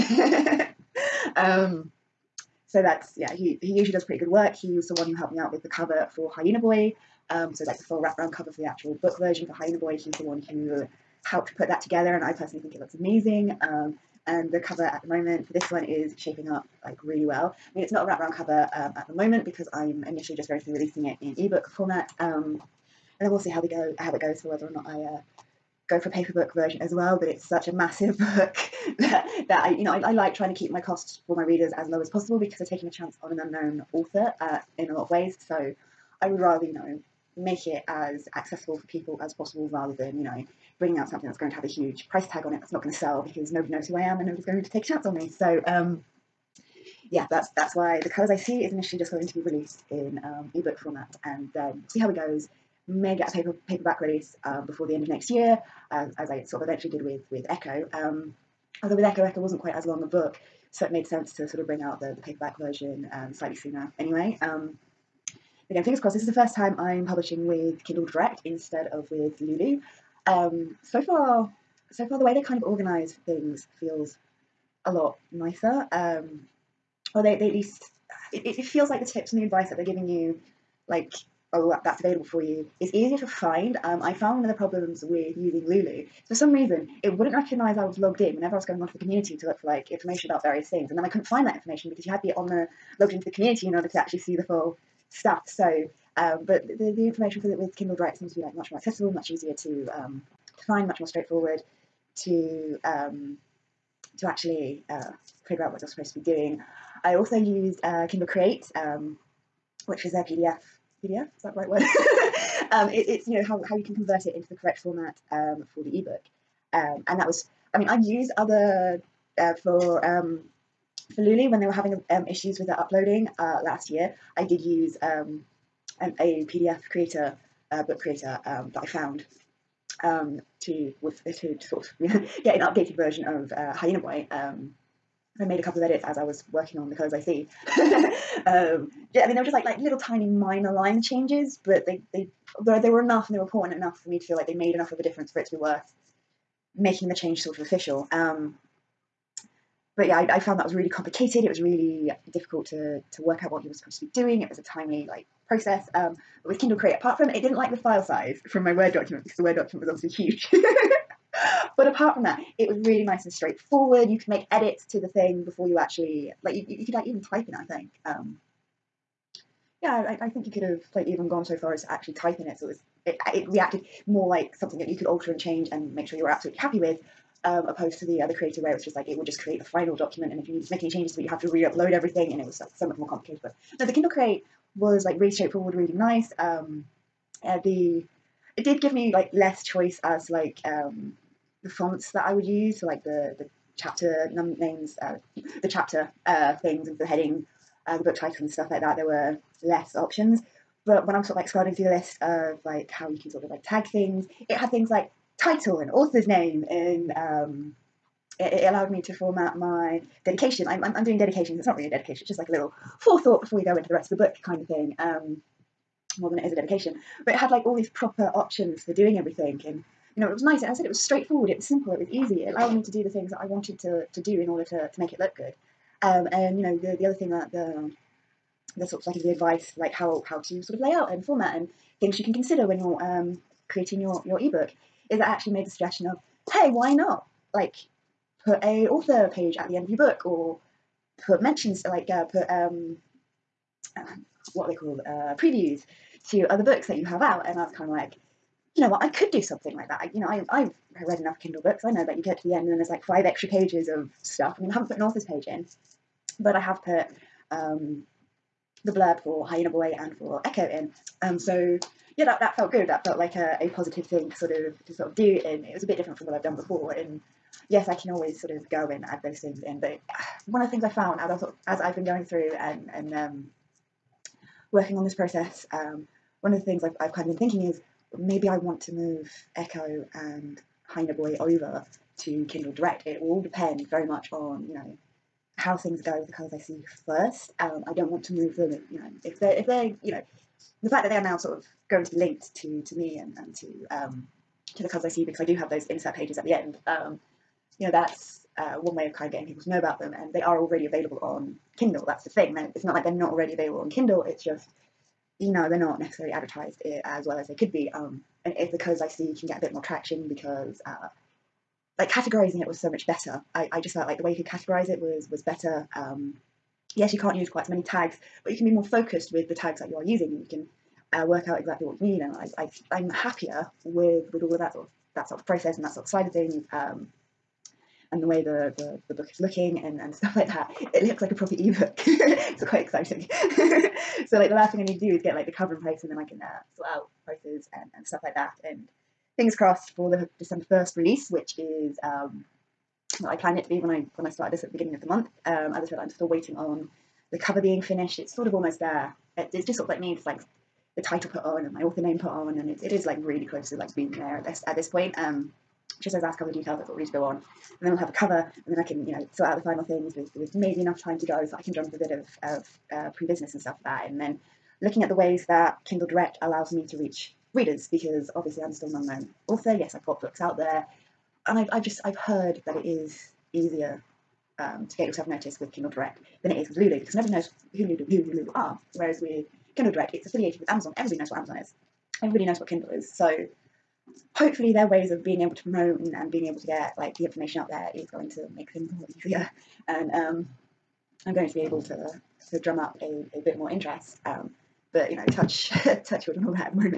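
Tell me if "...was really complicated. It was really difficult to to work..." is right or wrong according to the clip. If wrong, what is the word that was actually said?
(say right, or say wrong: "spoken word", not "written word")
right.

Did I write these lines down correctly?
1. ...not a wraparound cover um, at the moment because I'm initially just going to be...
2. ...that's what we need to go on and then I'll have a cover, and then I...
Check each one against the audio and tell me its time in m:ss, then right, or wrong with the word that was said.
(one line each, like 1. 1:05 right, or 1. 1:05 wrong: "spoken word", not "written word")
1. 0:17 right
2. 5:56 right.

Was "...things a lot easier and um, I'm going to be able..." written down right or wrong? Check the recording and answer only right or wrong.
right.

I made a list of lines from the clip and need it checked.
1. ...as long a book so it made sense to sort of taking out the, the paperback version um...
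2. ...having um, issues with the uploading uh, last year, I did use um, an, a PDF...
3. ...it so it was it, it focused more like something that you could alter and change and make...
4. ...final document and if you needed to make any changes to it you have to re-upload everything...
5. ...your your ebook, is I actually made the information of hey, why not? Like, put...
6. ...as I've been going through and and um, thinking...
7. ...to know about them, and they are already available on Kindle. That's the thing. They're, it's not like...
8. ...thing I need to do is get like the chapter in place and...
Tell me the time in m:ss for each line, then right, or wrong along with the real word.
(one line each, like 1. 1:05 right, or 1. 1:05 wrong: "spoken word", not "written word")
1. 0:59 wrong: "bring", not "taking"
2. 2:01 right
3. 2:52 wrong: "reacted", not "focused"
4. 2:59 right
5. 3:54 wrong: "suggestion", not "information"
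6. 4:31 wrong: "working", not "thinking"
7. 4:59 right
8. 5:34 wrong: "cover", not "chapter".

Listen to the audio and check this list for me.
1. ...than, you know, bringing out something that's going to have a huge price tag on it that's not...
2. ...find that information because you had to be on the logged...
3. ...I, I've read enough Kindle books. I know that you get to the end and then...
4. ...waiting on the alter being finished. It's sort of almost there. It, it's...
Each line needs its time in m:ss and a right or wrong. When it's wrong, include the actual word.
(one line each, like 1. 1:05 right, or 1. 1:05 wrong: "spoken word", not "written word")
1. 0:39 right
2. 1:31 right
3. 4:10 right
4. 5:46 wrong: "cover", not "alter".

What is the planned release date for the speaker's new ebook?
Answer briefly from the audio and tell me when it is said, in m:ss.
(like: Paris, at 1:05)
December 1st, at 5:40.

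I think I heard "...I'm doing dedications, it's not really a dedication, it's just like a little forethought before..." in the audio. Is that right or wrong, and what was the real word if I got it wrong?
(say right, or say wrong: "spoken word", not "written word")
right.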